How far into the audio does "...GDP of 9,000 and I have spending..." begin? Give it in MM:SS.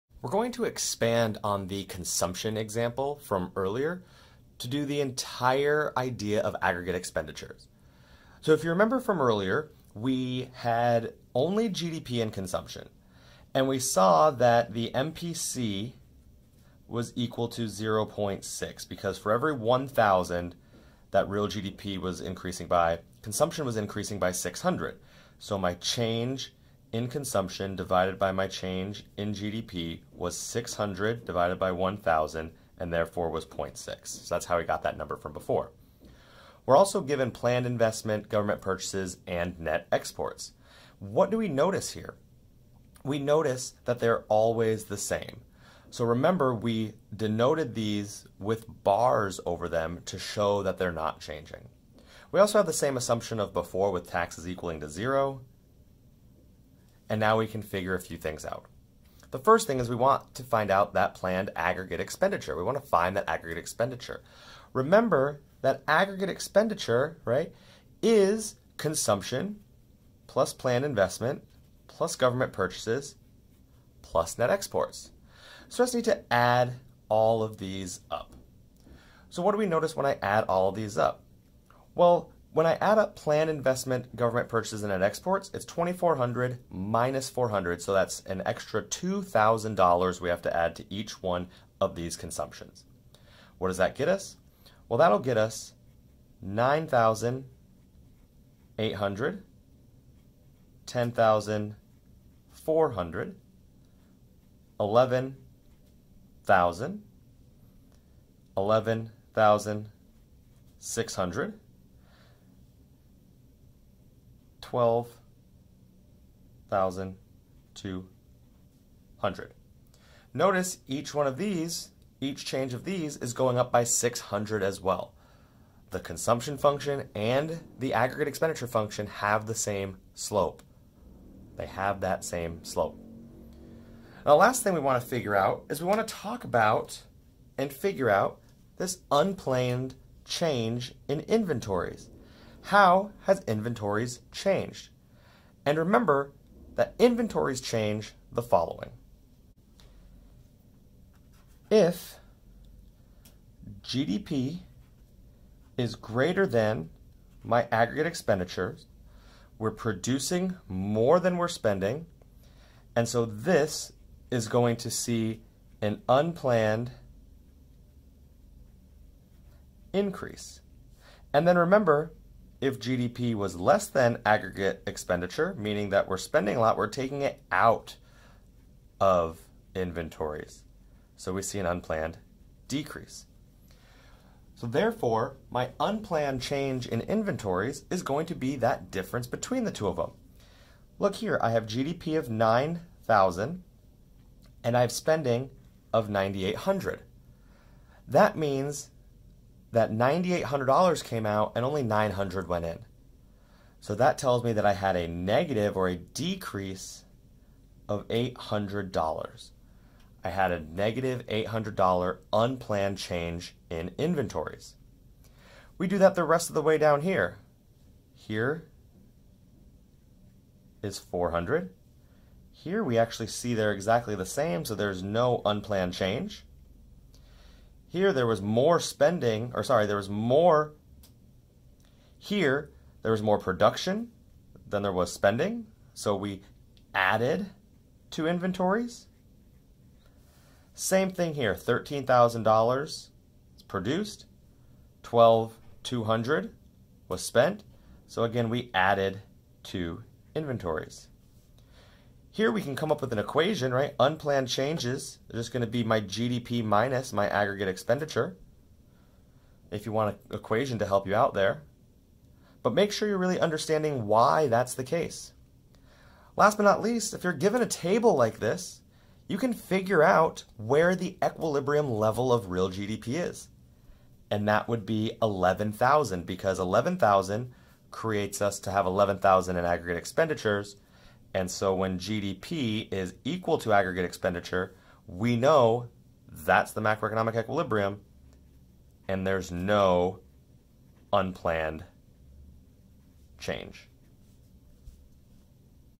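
03:11.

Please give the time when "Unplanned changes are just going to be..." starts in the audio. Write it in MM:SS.
04:13.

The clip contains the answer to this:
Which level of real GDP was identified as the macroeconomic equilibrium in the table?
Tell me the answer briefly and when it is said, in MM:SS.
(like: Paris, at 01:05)
11,000, at 04:34.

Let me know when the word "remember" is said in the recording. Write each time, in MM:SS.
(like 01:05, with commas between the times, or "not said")
00:08, 00:46, 01:04, 02:25, 02:51.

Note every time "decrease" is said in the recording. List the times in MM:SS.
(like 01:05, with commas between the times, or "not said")
03:02, 03:25.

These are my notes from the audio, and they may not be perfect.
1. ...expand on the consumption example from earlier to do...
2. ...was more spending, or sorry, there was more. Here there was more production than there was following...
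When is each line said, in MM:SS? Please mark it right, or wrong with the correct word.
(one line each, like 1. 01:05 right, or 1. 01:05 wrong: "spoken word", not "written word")
1. 00:00 right
2. 03:48 wrong: "spending", not "following".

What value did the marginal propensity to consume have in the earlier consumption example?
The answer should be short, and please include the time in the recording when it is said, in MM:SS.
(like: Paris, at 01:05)
0.6, at 00:32.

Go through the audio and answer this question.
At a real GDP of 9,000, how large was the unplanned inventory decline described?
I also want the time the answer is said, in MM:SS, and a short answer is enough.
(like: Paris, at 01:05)
$800, at 03:25.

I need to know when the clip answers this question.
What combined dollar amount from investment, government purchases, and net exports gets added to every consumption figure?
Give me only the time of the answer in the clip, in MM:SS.
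01:28.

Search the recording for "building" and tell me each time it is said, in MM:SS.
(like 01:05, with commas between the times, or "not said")
not said.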